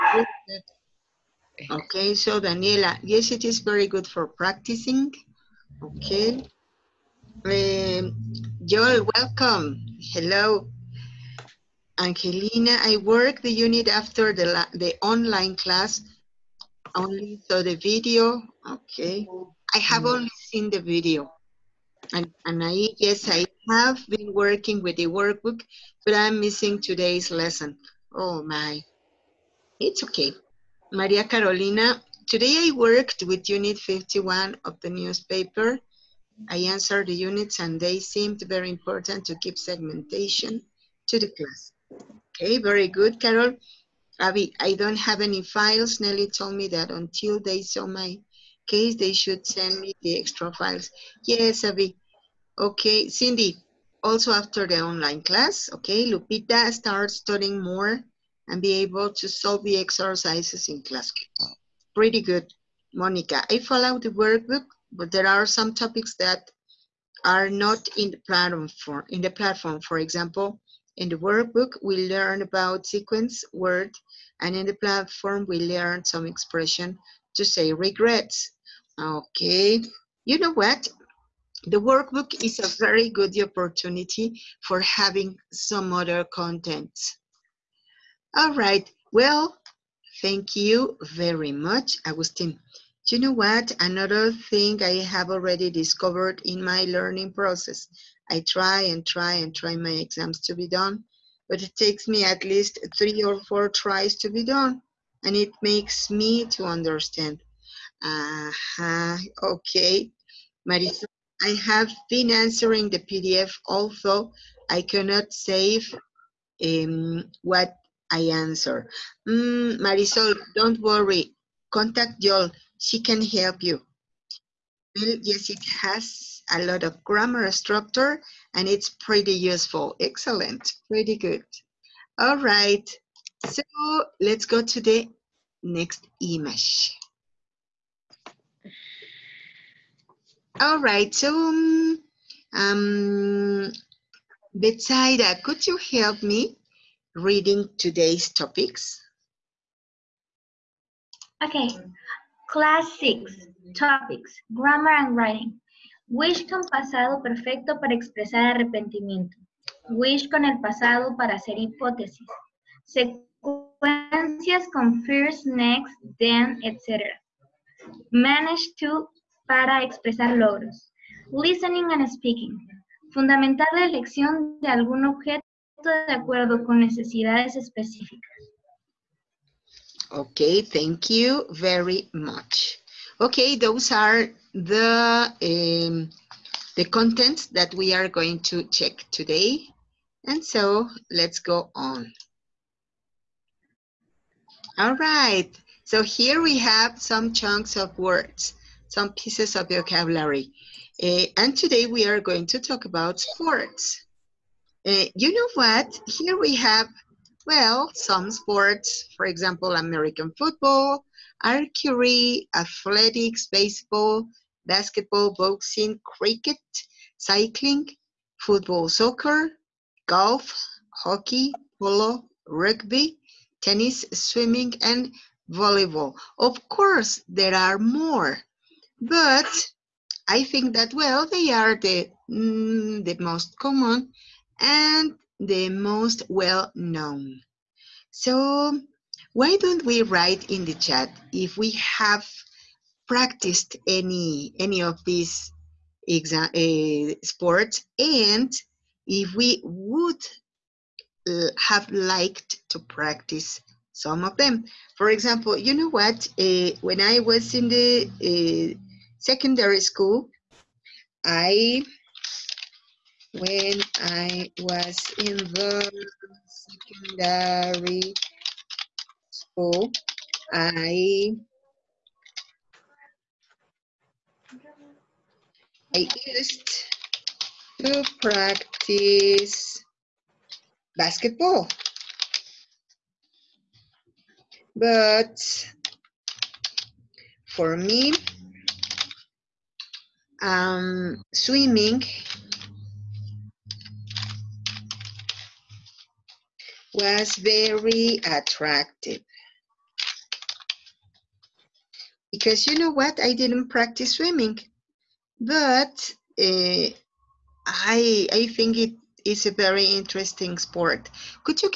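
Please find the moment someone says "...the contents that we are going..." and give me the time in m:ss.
3:06.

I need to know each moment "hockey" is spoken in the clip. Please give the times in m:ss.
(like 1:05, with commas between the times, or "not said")
3:40.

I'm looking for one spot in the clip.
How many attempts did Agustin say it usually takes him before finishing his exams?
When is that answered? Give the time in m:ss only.
1:42.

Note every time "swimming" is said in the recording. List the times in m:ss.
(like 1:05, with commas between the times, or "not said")
3:44, 4:51, 5:04.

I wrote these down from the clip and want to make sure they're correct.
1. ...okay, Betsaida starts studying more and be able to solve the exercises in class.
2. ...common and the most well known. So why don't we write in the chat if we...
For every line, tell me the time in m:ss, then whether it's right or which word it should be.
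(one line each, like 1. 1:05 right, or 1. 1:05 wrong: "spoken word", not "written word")
1. 0:55 wrong: "Lupita", not "Betsaida"
2. 3:53 right.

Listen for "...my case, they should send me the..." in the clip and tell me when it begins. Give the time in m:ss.
0:47.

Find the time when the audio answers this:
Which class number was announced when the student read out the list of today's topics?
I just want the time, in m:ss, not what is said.
2:32.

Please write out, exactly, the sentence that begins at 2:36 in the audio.
Wish con pasado perfecto para expresar arrepentimiento.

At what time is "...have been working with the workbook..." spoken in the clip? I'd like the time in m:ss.
0:23.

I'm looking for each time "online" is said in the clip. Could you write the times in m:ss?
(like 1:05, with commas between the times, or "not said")
0:15, 0:54.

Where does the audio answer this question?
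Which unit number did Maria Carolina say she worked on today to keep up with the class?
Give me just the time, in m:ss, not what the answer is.
0:33.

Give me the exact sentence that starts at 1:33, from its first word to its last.
Another thing I have already discovered in my learning process.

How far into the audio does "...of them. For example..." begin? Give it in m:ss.
4:14.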